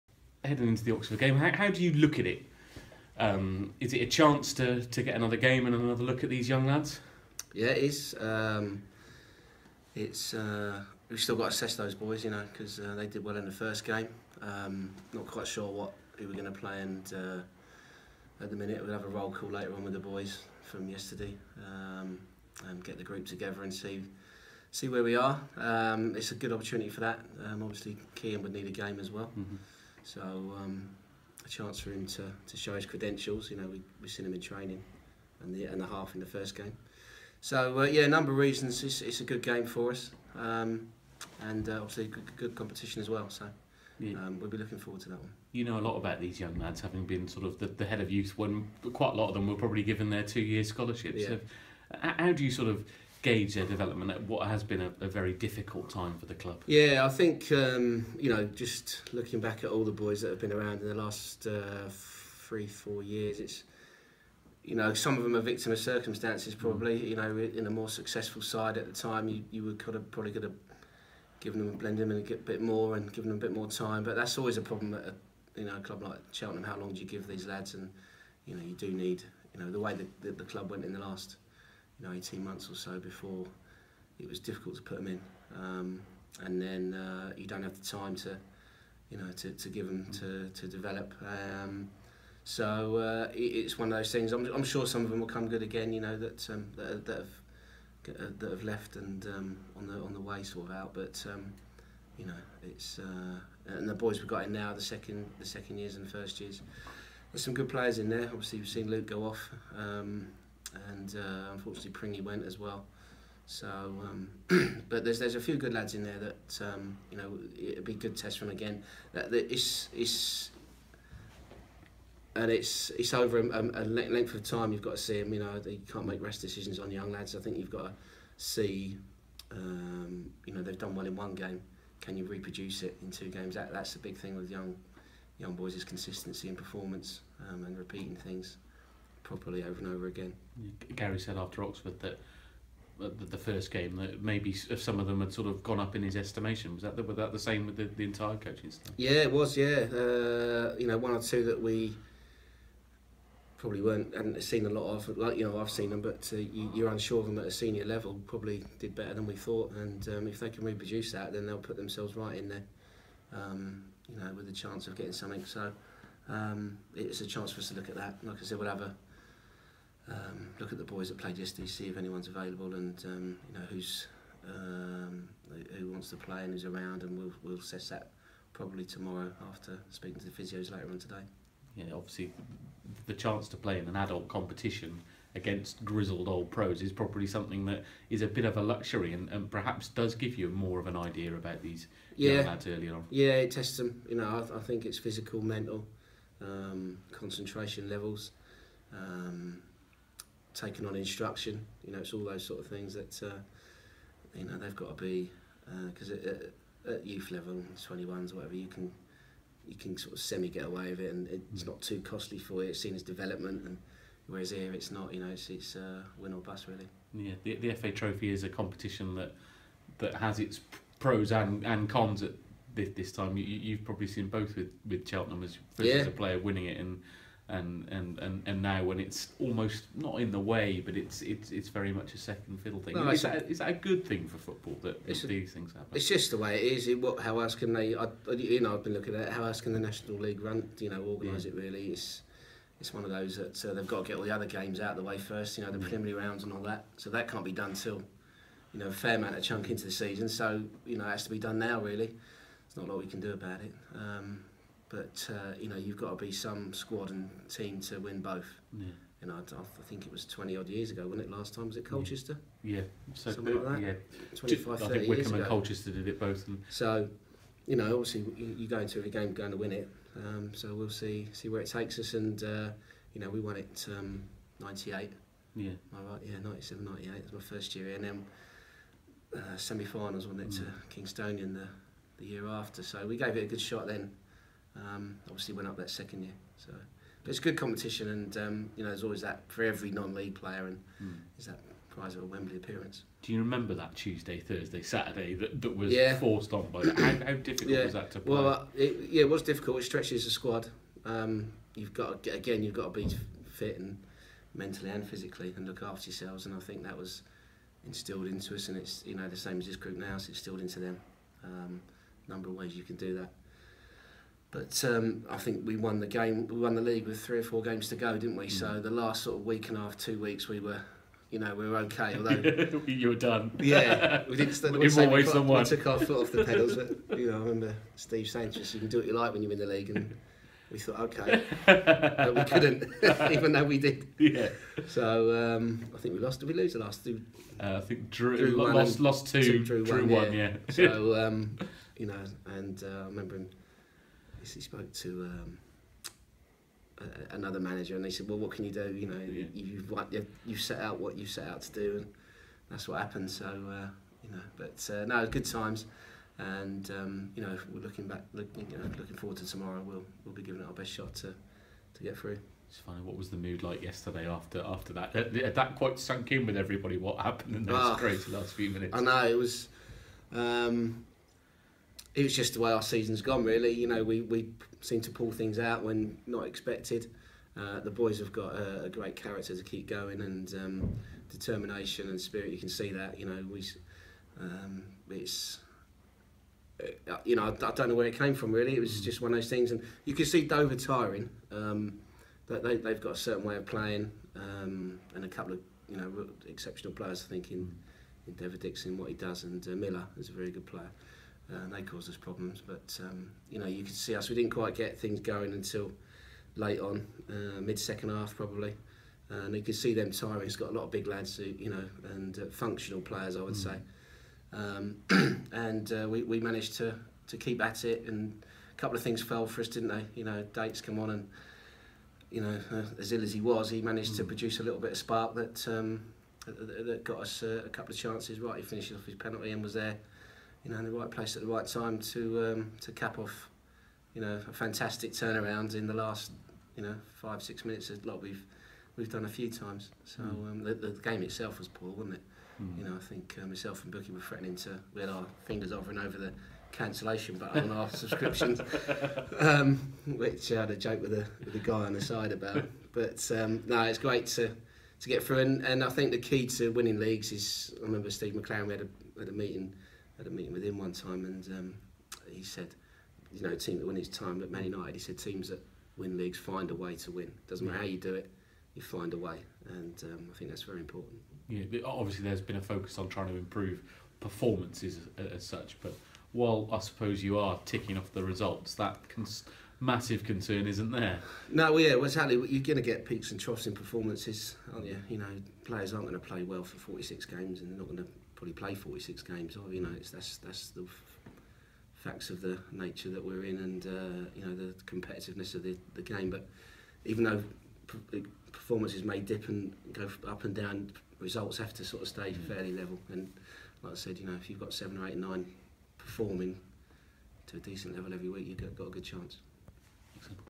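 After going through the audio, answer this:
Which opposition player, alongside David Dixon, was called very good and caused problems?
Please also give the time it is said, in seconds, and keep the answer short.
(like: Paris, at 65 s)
Miller, at 399 s.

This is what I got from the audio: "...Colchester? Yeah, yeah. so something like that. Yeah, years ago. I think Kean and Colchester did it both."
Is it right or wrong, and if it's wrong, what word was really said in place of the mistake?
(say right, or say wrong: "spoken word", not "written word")
wrong: "Wycombe", not "Kean".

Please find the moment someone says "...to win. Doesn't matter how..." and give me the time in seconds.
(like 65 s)
466 s.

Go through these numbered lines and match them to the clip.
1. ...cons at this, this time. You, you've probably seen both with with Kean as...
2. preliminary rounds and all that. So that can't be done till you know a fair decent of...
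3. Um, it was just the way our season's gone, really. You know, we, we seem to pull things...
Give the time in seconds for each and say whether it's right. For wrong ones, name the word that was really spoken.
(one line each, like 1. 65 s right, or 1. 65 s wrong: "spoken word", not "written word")
1. 221 s wrong: "Cheltenham", not "Kean"
2. 245 s wrong: "amount", not "decent"
3. 370 s right.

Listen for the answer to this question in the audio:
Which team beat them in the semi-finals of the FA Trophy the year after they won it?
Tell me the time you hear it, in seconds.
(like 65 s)
280 s.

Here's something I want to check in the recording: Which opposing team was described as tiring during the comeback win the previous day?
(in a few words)
Dover.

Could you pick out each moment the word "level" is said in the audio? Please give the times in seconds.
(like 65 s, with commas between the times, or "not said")
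157 s, 197 s, 207 s, 502 s, 507 s.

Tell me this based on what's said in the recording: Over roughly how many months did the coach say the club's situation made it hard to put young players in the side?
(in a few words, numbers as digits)
18.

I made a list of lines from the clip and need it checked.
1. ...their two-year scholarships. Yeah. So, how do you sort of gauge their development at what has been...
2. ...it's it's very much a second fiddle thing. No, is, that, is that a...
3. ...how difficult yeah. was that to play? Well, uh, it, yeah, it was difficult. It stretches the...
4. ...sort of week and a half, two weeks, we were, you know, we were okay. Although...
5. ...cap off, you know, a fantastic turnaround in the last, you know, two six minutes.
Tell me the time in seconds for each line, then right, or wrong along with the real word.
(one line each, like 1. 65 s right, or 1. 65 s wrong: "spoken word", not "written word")
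1. 50 s right
2. 231 s right
3. 296 s right
4. 319 s right
5. 432 s wrong: "five", not "two".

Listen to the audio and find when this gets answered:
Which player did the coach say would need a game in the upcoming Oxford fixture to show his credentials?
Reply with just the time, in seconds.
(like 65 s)
28 s.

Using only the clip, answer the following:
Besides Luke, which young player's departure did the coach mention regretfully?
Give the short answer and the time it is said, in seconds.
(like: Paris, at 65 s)
Pringy, at 111 s.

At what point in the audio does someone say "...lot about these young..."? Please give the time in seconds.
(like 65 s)
45 s.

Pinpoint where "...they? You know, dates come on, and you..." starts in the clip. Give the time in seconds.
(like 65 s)
419 s.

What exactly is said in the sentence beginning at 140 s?
Gary said after Oxford that the, first game that maybe some of them had sort of gone up in his estimation.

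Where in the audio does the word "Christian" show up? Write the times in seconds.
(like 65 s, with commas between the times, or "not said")
not said.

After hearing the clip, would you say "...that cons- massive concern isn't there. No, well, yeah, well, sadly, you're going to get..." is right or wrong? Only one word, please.
right.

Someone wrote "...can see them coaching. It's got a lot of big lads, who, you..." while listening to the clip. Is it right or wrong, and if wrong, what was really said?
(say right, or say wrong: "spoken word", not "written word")
wrong: "tiring", not "coaching".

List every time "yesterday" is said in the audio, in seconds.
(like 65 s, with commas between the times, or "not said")
20 s, 171 s, 363 s.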